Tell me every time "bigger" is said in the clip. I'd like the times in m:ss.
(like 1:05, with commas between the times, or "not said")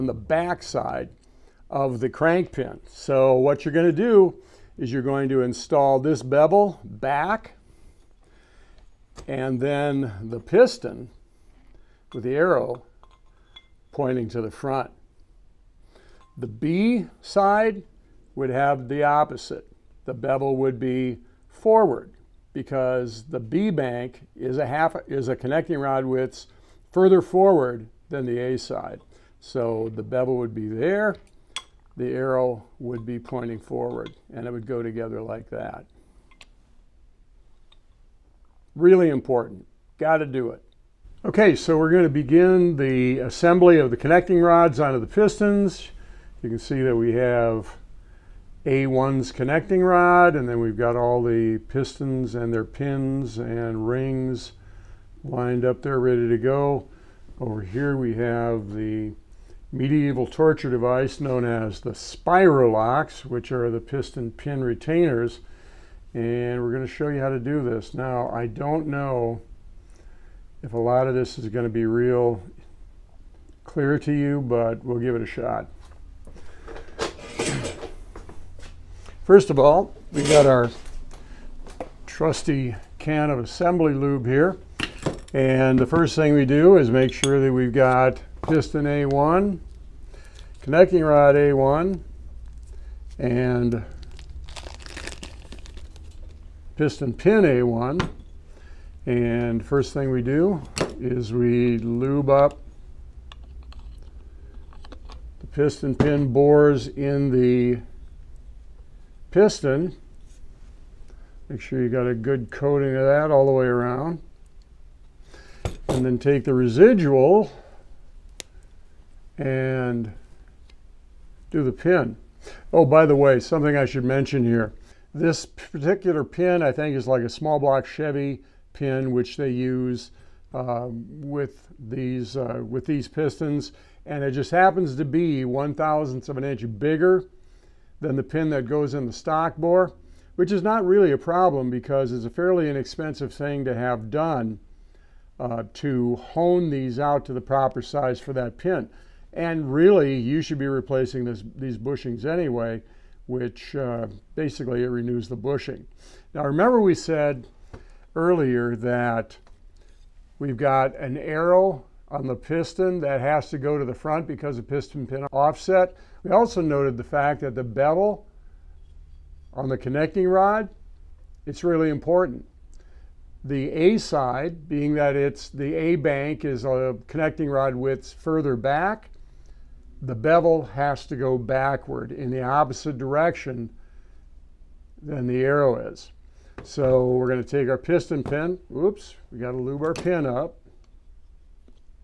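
2:16.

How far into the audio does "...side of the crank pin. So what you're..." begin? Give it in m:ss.
0:00.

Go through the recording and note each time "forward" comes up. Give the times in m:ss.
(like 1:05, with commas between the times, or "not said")
0:21, 0:27, 0:33.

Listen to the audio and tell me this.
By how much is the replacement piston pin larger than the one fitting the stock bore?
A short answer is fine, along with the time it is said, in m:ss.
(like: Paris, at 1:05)
one thousandth of an inch, at 2:15.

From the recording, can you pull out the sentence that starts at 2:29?
And really, you should be replacing this, these bushings anyway, which uh, basically it renews the bushing.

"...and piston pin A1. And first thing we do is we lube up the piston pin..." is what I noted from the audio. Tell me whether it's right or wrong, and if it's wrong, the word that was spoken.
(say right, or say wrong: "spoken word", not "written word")
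right.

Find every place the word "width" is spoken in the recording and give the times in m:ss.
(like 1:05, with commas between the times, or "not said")
0:26, 2:57.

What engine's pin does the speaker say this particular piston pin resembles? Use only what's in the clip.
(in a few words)
small block Chevy.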